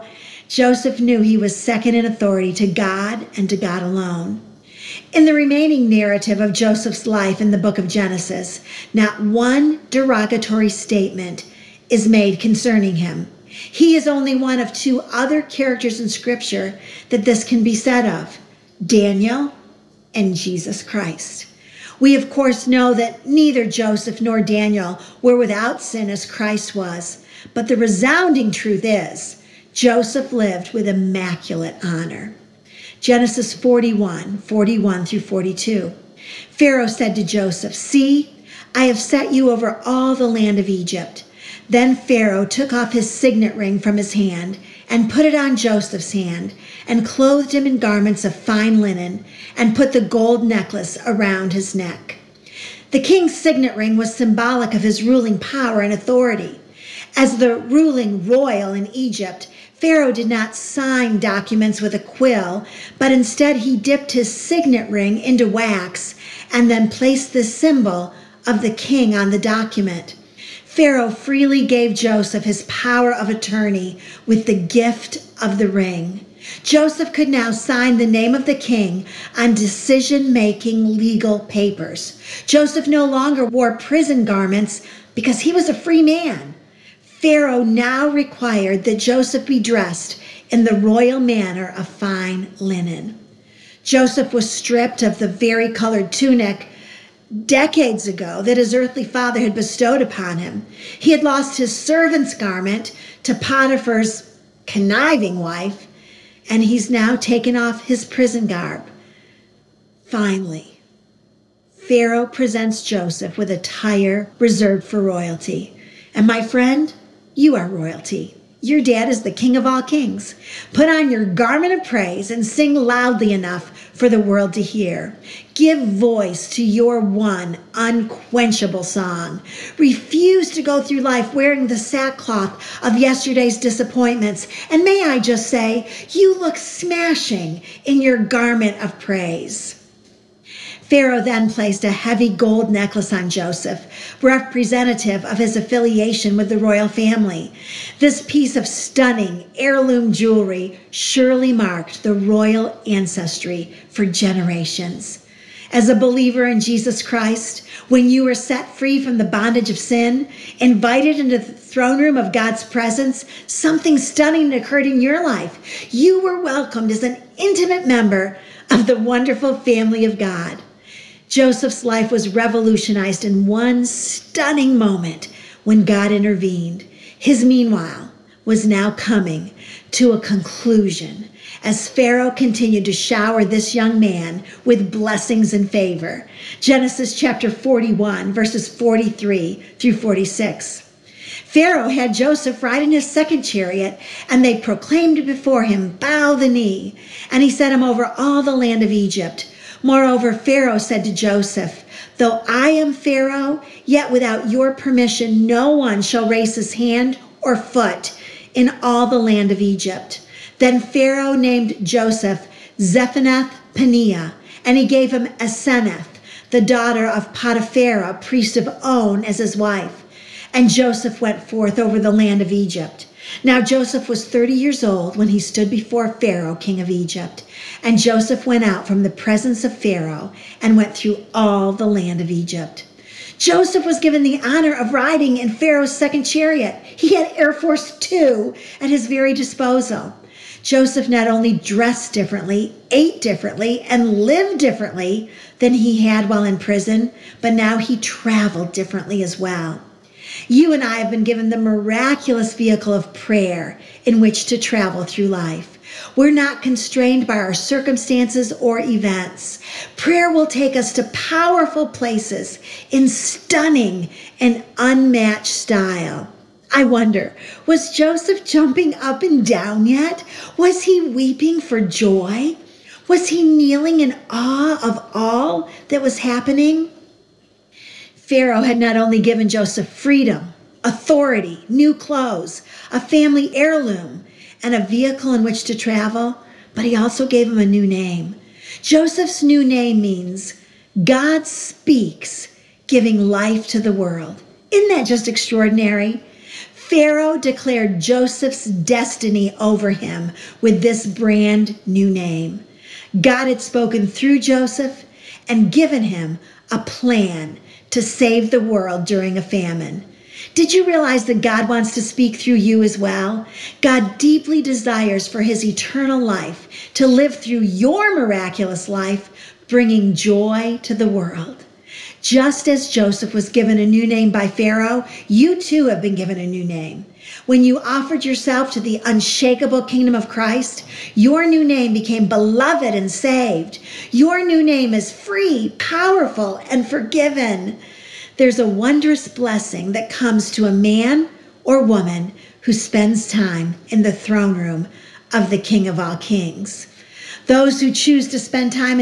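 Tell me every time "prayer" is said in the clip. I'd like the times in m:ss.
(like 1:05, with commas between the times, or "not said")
4:13, 4:19.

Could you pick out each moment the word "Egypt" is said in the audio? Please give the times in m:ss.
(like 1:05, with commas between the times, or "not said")
0:40, 0:58, 3:18, 3:29, 3:42, 3:46, 3:52.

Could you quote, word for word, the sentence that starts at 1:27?
Pharaoh now required that Joseph be dressed in the royal manner of fine linen.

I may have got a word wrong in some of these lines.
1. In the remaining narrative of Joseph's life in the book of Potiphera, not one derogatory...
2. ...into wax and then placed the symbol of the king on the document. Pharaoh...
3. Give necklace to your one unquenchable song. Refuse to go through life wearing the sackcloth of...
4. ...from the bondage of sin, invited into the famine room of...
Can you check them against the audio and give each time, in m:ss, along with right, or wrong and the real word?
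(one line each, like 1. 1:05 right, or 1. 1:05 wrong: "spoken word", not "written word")
1. 0:05 wrong: "Genesis", not "Potiphera"
2. 1:05 right
3. 2:05 wrong: "voice", not "necklace"
4. 2:39 wrong: "throne", not "famine".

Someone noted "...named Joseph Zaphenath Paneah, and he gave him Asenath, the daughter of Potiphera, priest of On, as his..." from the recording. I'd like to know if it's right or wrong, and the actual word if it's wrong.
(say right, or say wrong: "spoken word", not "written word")
right.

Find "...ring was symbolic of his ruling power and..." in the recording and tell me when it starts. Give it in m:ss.
0:53.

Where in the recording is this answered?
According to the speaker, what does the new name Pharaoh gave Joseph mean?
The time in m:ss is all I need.
4:51.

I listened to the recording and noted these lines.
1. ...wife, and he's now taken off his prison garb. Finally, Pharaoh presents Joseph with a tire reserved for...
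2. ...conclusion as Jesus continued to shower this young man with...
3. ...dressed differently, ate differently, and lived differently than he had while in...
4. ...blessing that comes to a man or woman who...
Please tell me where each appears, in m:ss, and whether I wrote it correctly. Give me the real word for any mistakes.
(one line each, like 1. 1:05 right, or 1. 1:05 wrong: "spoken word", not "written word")
1. 1:45 right
2. 3:00 wrong: "Pharaoh", not "Jesus"
3. 4:01 right
4. 5:39 right.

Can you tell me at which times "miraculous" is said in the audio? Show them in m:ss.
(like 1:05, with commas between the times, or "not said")
4:11, 5:18.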